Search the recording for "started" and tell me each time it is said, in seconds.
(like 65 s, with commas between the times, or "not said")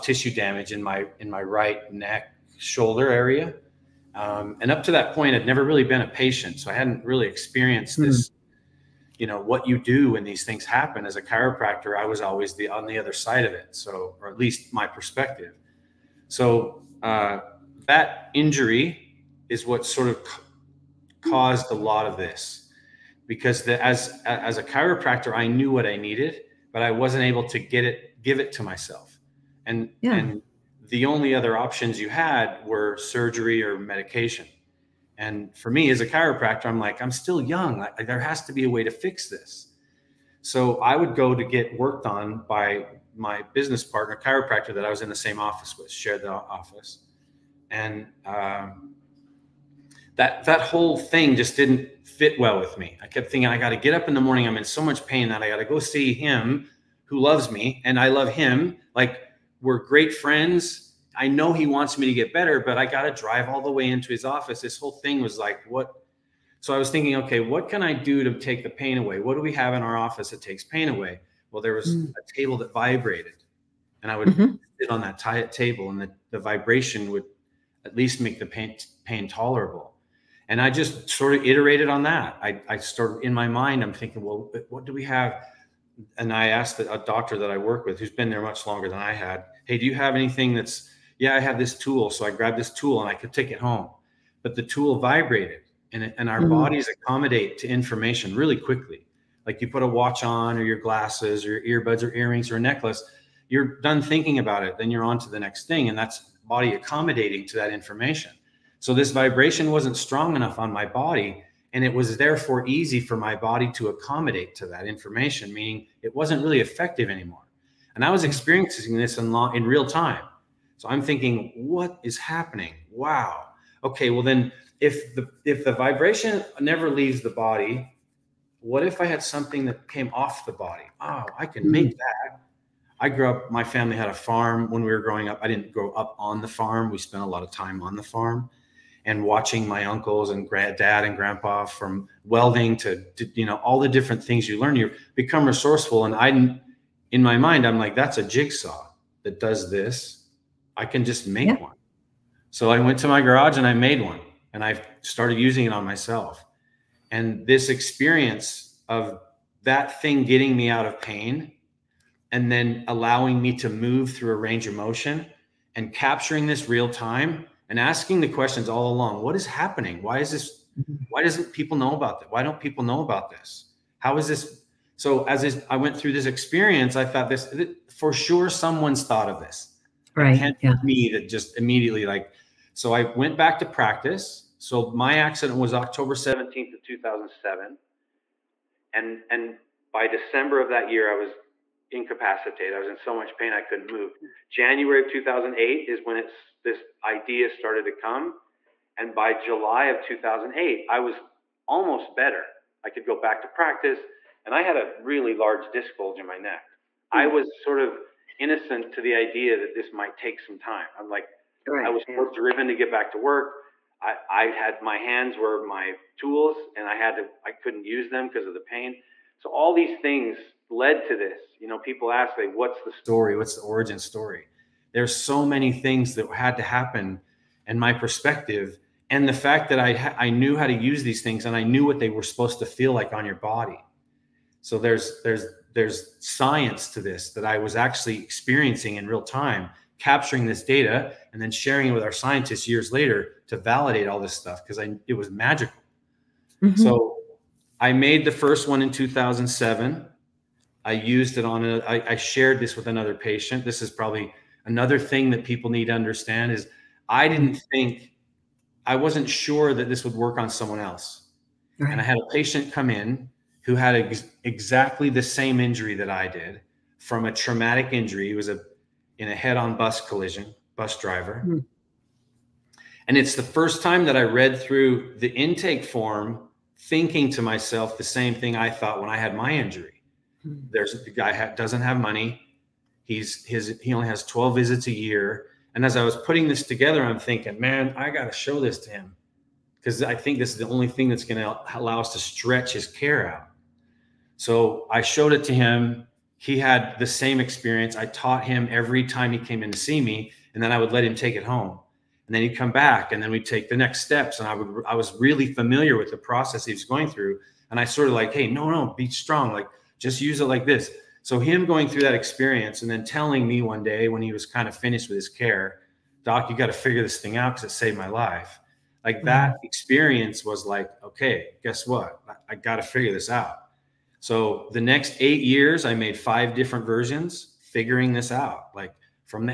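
82 s, 155 s, 197 s.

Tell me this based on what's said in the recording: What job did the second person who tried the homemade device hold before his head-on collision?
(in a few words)
bus driver.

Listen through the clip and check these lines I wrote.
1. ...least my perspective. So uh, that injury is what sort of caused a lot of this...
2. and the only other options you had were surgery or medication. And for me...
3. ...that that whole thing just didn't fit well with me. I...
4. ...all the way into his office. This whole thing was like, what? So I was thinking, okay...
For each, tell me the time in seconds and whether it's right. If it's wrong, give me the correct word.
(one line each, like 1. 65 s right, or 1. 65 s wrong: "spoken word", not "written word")
1. 14 s right
2. 30 s right
3. 50 s right
4. 63 s right.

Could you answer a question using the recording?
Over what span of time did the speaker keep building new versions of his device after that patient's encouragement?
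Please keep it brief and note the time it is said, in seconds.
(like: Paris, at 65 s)
8 years, at 325 s.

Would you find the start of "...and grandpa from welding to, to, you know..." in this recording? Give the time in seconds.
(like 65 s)
141 s.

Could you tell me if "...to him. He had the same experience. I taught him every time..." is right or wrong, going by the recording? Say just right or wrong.
right.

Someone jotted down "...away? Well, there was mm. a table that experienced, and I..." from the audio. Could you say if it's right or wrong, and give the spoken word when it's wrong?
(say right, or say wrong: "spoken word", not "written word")
wrong: "vibrated", not "experienced".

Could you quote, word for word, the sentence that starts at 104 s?
Then you're on to the next thing.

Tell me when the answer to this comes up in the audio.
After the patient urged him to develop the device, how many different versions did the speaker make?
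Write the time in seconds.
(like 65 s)
326 s.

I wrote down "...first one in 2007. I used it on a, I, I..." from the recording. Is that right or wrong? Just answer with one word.
right.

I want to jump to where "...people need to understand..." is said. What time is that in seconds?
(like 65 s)
255 s.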